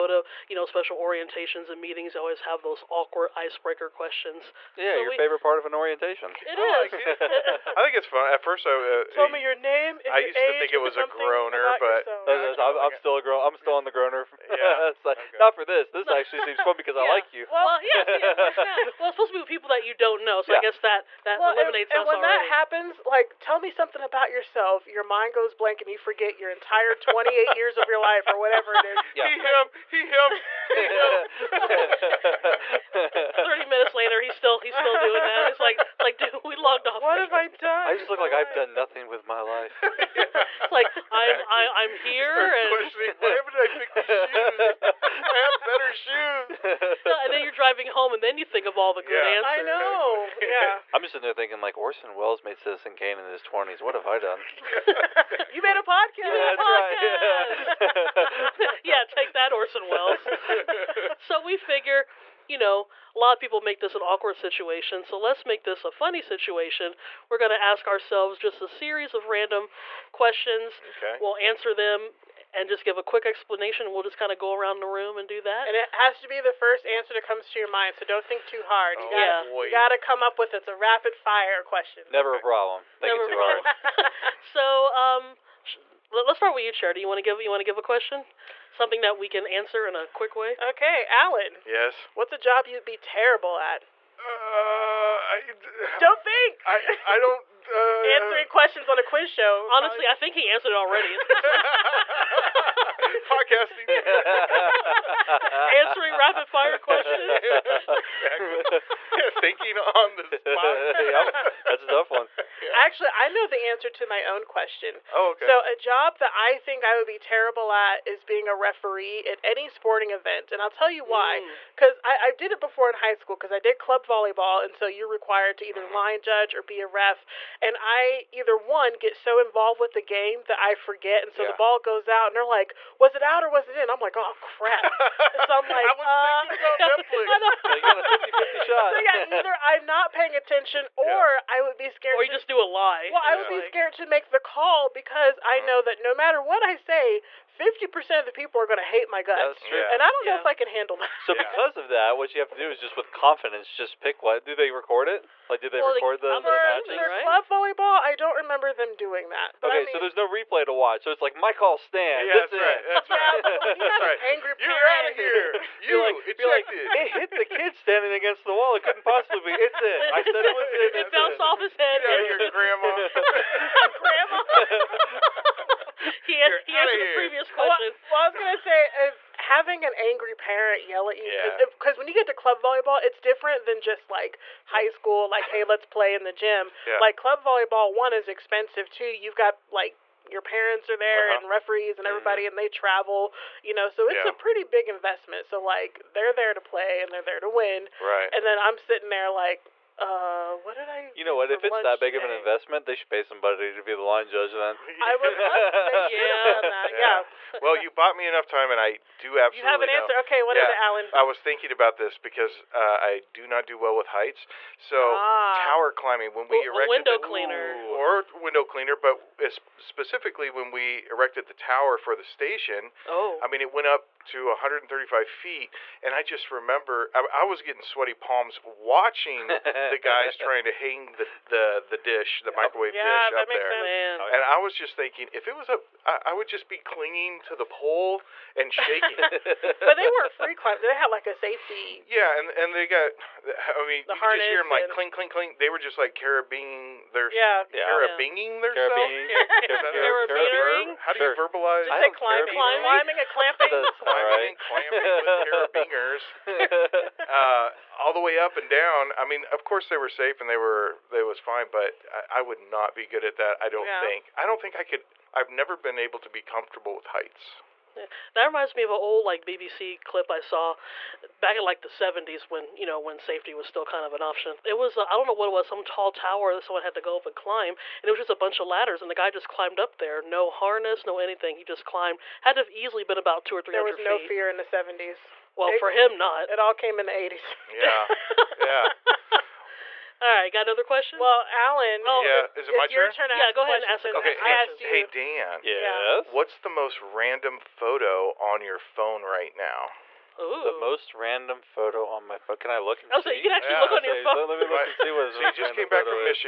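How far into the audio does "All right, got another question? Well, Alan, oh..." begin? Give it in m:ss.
4:50.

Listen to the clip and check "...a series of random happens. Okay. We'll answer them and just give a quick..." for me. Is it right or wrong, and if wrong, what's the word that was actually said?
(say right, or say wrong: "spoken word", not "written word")
wrong: "questions", not "happens".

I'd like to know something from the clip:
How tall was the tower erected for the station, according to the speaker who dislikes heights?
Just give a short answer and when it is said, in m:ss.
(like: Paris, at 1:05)
135 feet, at 3:44.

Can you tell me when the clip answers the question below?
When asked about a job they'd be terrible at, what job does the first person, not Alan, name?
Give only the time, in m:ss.
1:58.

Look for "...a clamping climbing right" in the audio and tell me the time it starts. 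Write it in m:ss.
4:13.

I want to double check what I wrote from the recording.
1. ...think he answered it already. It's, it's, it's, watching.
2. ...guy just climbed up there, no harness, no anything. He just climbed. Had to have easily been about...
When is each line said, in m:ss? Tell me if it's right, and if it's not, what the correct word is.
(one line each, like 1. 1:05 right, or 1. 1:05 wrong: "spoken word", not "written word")
1. 1:40 wrong: "podcasting", not "watching"
2. 4:39 right.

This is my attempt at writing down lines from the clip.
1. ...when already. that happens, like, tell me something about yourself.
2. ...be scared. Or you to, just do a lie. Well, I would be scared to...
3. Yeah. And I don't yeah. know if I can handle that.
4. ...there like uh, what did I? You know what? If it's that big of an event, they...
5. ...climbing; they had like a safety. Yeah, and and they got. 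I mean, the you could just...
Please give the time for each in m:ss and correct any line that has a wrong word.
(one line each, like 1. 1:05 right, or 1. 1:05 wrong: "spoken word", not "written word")
1. 0:22 right
2. 2:21 right
3. 2:29 right
4. 3:19 wrong: "investment", not "event"
5. 4:00 right.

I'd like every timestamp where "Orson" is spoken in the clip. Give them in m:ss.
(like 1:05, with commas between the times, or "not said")
0:51, 0:59.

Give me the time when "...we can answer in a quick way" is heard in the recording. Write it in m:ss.
1:29.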